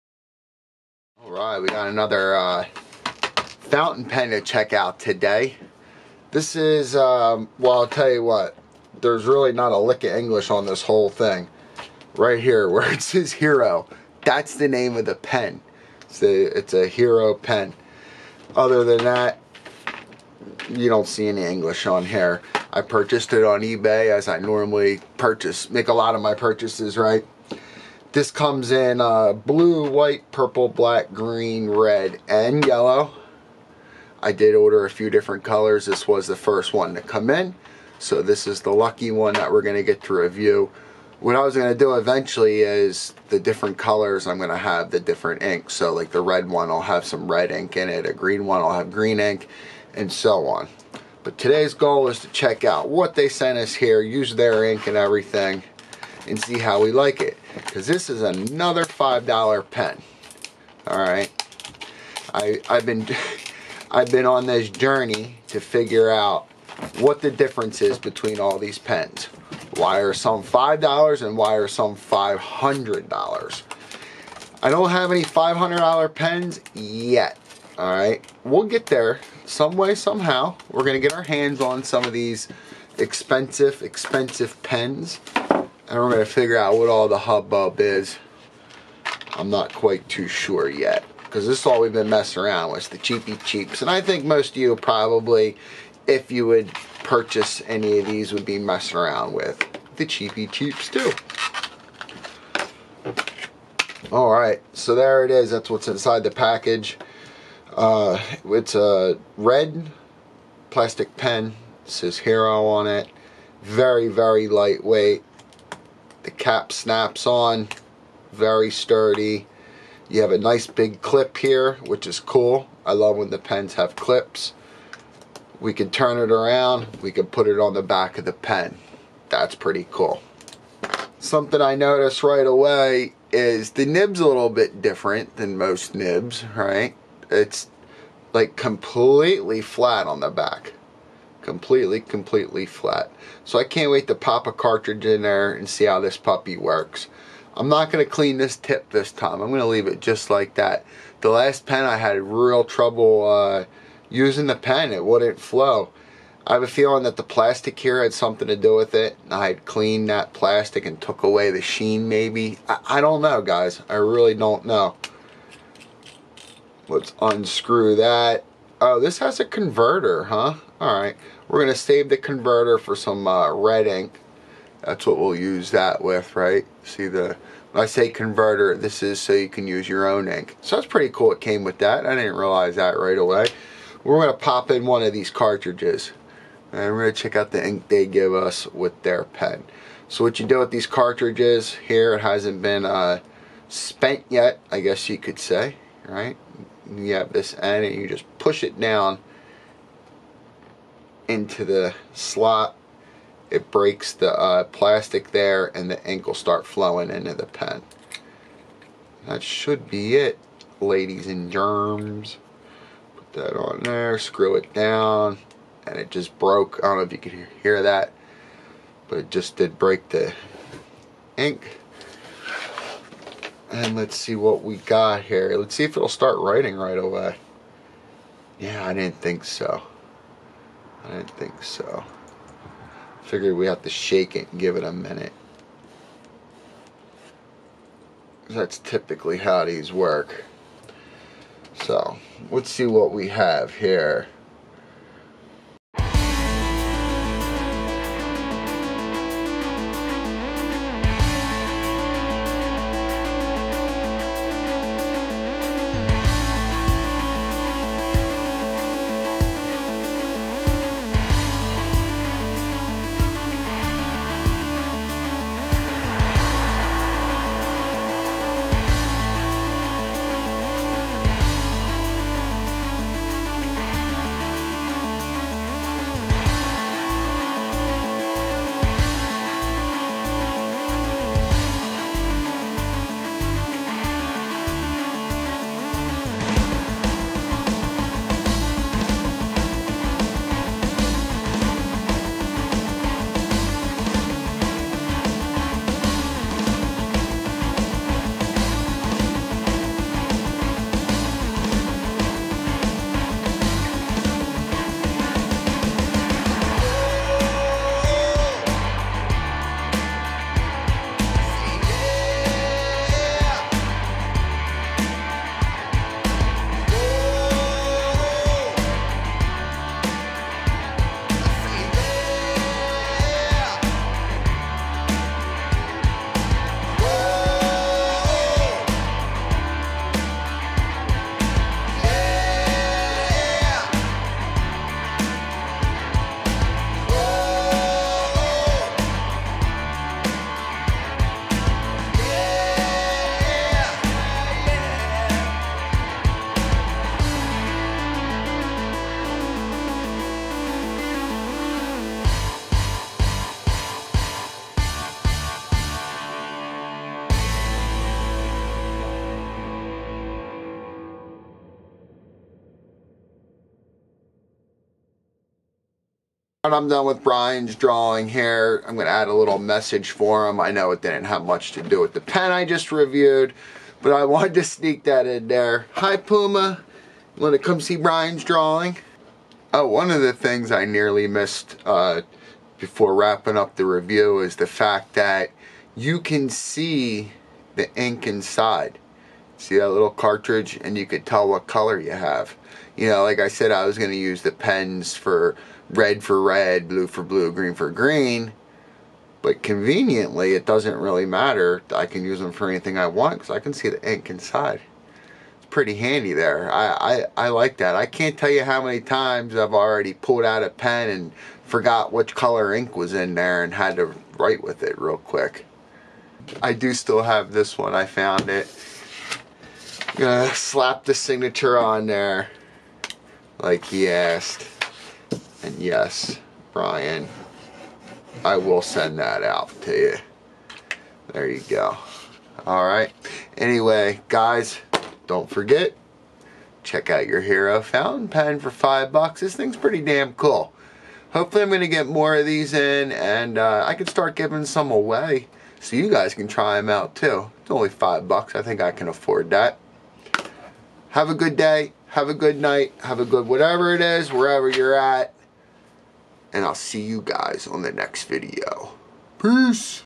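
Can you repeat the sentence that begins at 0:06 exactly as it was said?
This is, um, well, I'll tell you what, there's really not a lick of English on this whole thing.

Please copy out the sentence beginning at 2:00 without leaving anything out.
You have a nice big clip here, which is cool.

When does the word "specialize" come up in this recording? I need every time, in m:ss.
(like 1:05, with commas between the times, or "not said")
not said.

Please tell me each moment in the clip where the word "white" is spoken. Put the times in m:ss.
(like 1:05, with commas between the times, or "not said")
0:29.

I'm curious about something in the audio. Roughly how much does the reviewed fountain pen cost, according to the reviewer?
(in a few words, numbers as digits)
$5.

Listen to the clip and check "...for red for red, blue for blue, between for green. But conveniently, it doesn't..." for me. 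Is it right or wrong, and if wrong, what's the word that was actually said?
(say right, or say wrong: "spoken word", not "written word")
wrong: "green", not "between".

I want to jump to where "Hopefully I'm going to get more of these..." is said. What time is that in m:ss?
7:21.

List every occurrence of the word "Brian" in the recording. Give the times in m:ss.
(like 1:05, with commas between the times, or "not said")
6:07, 6:17, 7:06.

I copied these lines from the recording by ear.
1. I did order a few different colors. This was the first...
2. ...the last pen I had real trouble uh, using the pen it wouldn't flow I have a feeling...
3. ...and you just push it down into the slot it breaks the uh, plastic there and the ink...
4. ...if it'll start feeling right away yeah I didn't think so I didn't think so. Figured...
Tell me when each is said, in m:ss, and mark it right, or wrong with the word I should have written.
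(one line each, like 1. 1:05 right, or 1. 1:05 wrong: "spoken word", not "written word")
1. 0:34 right
2. 2:31 right
3. 3:17 right
4. 3:45 wrong: "writing", not "feeling".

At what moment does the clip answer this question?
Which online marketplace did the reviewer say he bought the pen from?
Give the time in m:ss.
0:23.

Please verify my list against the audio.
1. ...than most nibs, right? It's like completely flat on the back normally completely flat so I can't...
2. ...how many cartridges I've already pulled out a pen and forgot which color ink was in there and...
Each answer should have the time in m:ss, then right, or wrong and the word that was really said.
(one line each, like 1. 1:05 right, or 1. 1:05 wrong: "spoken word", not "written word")
1. 2:15 wrong: "completely", not "normally"
2. 6:48 wrong: "times", not "cartridges".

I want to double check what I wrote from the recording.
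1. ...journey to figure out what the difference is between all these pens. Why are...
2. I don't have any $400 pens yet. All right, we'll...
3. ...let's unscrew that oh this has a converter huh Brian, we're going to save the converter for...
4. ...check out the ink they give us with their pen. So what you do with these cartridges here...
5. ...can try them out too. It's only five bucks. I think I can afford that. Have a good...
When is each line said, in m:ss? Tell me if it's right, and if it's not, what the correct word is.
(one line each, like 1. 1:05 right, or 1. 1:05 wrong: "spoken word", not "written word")
1. 1:04 right
2. 1:14 wrong: "500", not "400"
3. 2:46 wrong: "Alright", not "Brian"
4. 3:07 right
5. 7:26 right.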